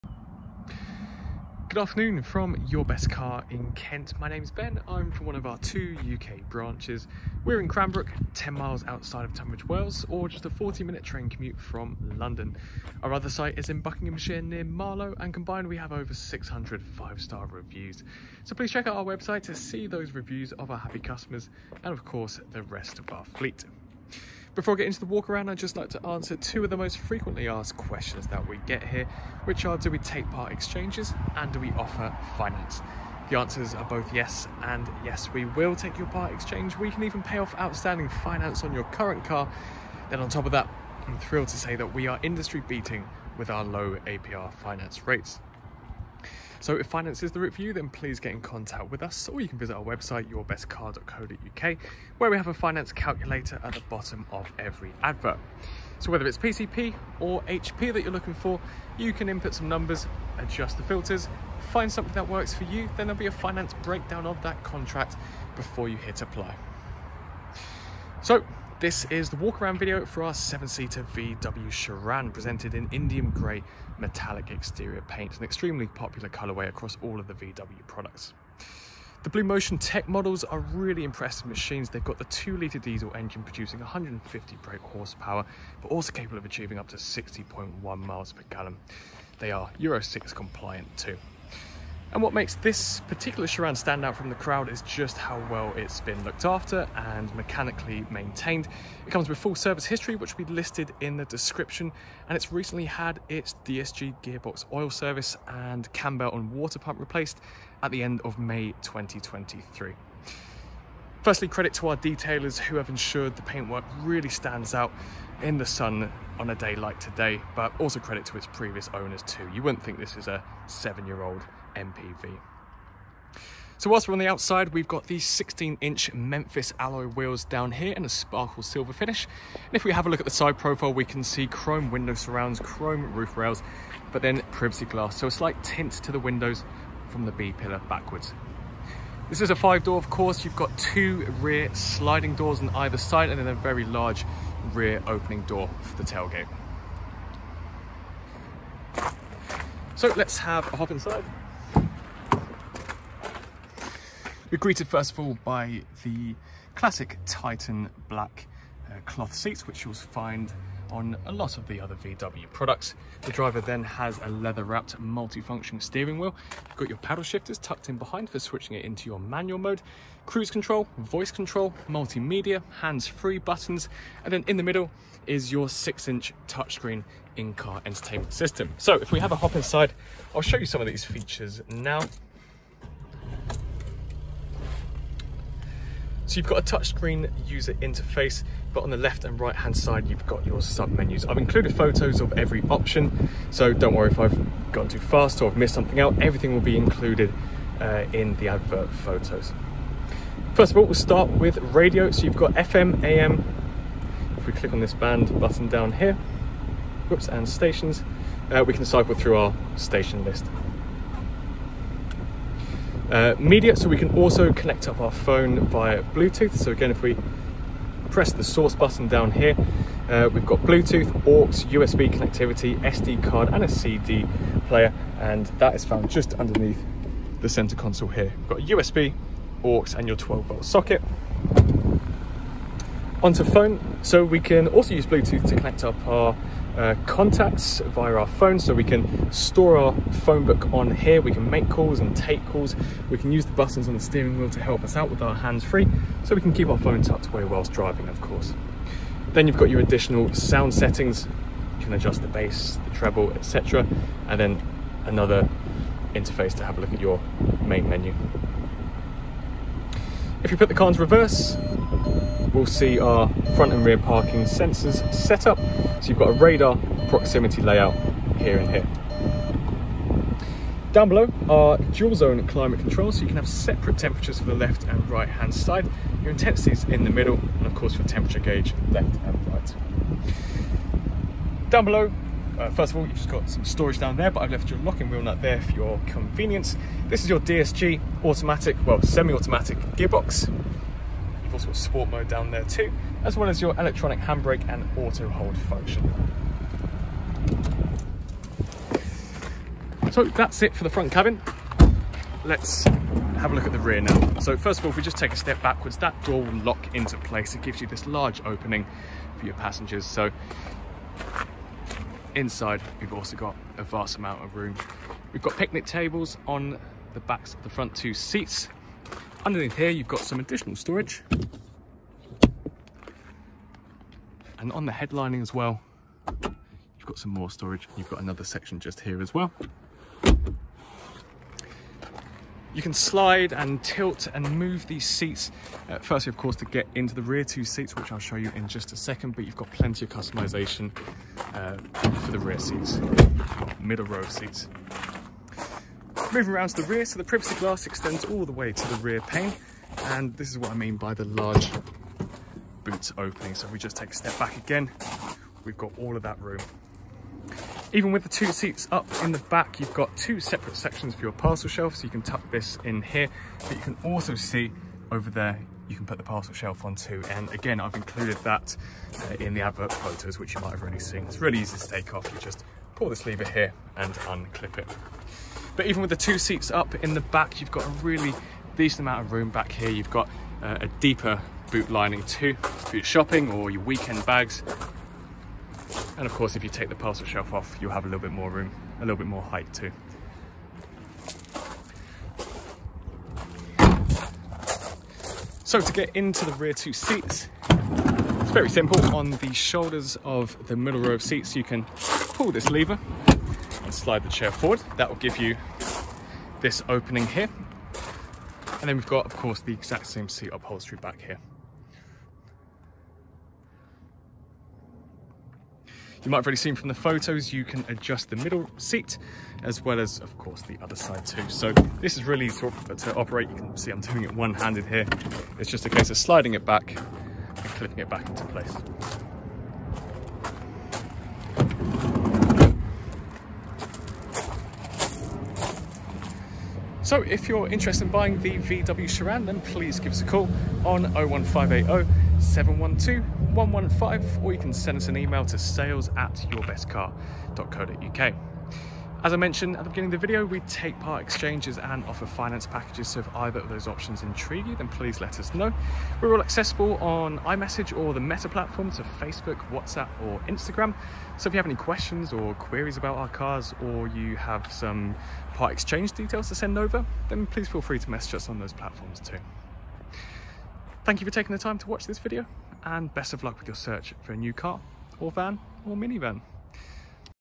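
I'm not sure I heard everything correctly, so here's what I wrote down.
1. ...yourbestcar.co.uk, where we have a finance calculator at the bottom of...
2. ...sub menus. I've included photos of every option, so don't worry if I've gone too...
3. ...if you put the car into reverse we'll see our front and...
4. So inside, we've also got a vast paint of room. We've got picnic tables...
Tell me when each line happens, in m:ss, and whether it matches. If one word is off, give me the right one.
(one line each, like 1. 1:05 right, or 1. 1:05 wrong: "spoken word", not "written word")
1. 0:50 right
2. 3:10 right
3. 4:20 right
4. 5:10 wrong: "amount", not "paint".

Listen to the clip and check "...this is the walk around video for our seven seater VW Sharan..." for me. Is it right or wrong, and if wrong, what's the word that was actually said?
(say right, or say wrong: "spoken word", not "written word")
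right.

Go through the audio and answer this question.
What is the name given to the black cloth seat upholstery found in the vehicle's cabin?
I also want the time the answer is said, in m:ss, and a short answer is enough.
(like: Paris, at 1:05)
Titan black, at 2:37.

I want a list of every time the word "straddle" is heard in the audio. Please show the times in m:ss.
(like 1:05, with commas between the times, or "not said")
not said.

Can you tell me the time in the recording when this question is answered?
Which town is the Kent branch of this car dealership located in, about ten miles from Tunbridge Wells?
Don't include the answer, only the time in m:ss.
0:07.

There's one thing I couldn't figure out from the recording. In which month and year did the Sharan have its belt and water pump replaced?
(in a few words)
May 2023.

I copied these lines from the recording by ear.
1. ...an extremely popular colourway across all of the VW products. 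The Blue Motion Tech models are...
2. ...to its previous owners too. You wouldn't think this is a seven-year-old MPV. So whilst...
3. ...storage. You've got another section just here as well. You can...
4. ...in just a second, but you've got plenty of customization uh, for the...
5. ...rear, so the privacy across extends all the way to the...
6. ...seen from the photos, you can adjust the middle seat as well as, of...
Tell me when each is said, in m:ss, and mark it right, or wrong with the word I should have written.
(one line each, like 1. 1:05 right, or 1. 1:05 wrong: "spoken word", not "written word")
1. 1:15 right
2. 1:58 right
3. 5:27 right
4. 5:38 right
5. 5:46 wrong: "glass", not "across"
6. 6:56 right.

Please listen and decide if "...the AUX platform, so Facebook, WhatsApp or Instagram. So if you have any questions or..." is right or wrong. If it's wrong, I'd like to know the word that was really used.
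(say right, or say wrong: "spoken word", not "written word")
wrong: "Meta", not "AUX".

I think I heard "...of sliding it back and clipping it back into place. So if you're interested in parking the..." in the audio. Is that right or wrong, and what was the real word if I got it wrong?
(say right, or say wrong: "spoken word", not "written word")
wrong: "buying", not "parking".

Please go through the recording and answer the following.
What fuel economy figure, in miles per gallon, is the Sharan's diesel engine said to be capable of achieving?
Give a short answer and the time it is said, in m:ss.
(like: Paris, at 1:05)
60.1, at 1:26.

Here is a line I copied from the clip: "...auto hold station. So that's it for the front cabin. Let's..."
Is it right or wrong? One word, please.
wrong.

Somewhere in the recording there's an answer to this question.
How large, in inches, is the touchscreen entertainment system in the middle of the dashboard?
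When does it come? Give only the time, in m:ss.
2:55.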